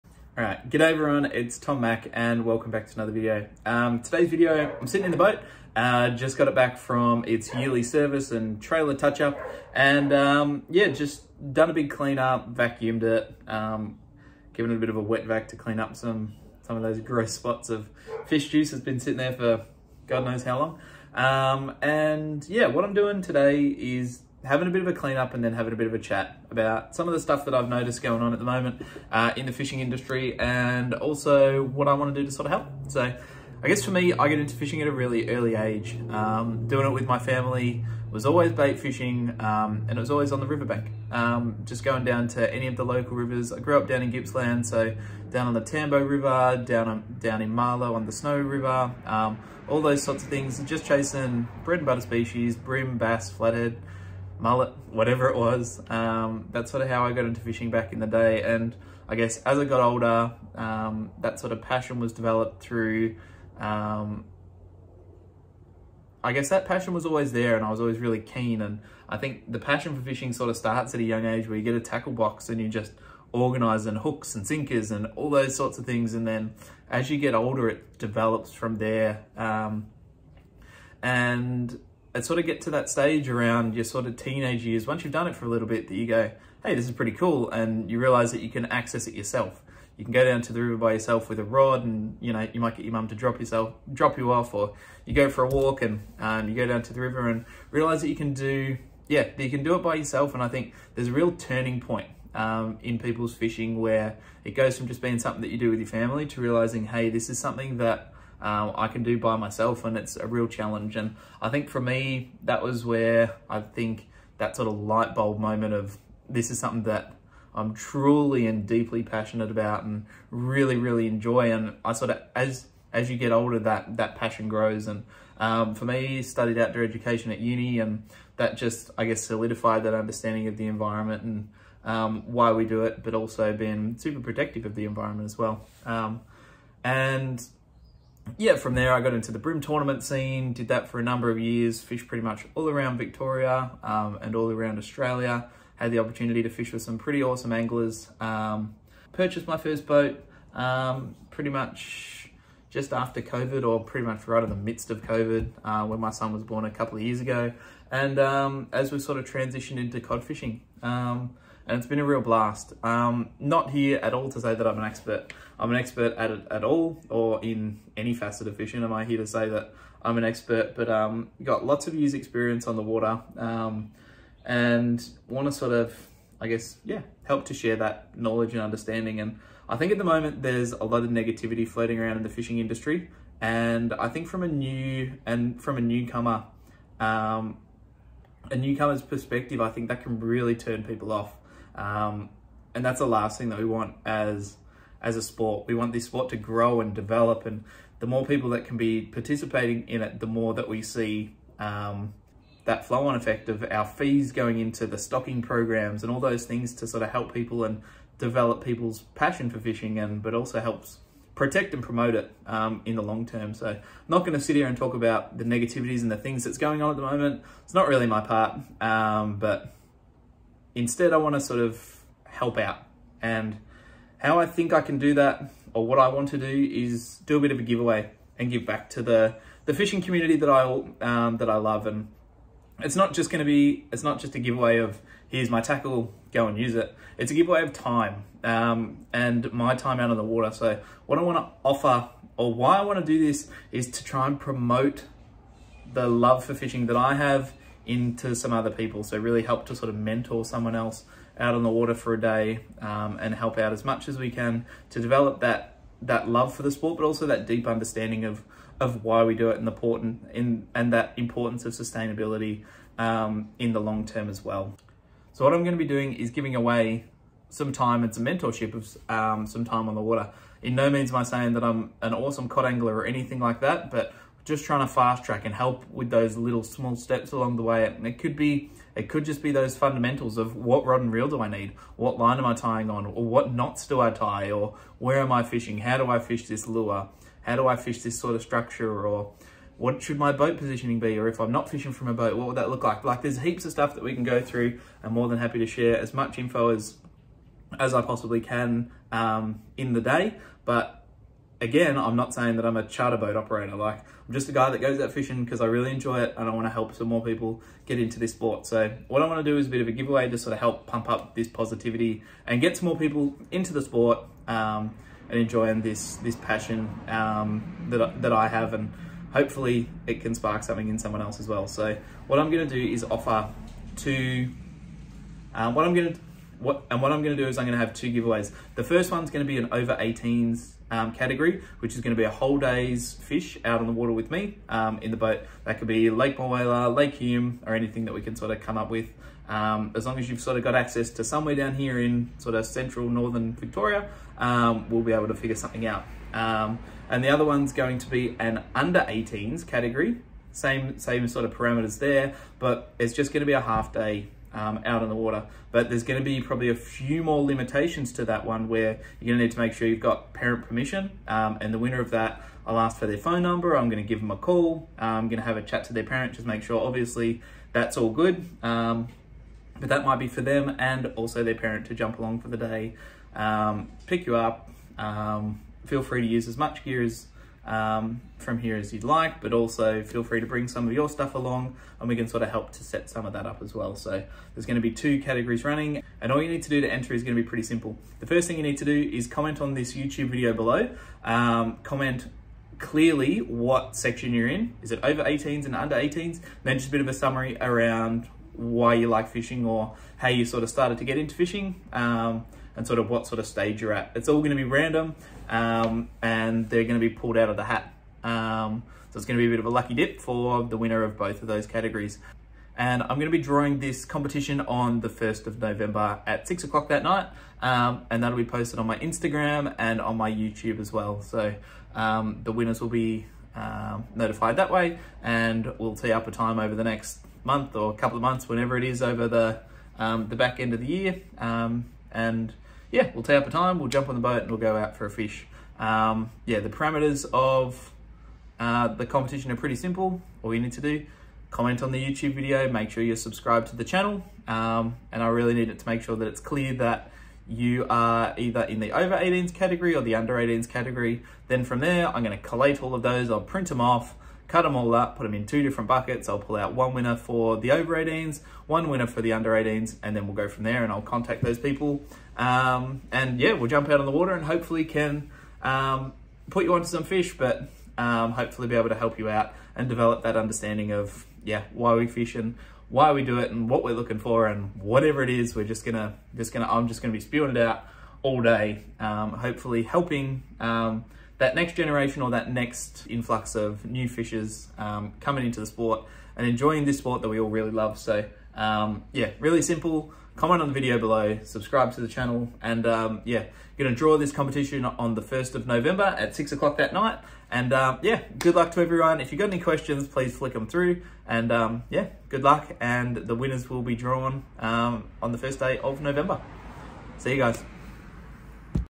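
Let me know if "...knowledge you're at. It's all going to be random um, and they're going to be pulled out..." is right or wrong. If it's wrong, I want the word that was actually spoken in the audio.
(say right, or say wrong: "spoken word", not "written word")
wrong: "stage", not "knowledge".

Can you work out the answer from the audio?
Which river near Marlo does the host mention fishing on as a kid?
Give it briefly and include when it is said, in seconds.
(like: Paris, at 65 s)
Snow River, at 48 s.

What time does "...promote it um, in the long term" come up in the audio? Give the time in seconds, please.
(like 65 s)
211 s.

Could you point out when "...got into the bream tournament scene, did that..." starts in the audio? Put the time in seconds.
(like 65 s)
139 s.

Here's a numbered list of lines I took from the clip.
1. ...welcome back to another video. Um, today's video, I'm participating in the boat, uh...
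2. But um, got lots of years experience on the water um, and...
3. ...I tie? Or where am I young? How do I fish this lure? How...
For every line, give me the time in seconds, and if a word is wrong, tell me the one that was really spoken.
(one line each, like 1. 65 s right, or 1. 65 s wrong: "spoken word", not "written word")
1. 2 s wrong: "sitting", not "participating"
2. 170 s right
3. 284 s wrong: "fishing", not "young".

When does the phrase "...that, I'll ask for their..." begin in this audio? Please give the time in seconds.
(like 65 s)
362 s.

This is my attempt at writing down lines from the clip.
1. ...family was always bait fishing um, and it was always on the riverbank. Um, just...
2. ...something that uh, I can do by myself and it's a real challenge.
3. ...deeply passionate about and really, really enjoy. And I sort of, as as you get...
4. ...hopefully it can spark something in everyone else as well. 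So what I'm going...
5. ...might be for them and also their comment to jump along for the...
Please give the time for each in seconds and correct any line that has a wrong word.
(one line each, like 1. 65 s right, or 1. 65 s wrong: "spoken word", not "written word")
1. 37 s right
2. 107 s right
3. 118 s right
4. 319 s wrong: "someone", not "everyone"
5. 370 s wrong: "parent", not "comment".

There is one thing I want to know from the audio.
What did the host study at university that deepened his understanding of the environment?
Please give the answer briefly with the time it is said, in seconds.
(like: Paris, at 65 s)
Outdoor education, at 126 s.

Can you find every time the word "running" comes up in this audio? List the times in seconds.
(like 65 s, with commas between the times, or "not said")
385 s.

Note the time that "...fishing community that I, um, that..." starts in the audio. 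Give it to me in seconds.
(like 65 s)
229 s.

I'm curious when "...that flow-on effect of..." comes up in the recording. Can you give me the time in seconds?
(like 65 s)
202 s.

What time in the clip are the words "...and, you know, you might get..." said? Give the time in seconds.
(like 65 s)
91 s.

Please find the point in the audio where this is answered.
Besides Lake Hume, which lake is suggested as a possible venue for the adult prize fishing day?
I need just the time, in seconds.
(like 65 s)
336 s.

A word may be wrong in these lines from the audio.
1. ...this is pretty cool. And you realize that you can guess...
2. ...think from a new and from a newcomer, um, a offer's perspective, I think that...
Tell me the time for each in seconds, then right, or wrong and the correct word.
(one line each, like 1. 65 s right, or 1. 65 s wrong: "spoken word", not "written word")
1. 86 s wrong: "access", not "guess"
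2. 184 s wrong: "newcomer", not "offer".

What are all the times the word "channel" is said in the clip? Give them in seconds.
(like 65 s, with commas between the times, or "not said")
443 s, 492 s.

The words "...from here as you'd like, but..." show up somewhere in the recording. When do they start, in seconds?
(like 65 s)
378 s.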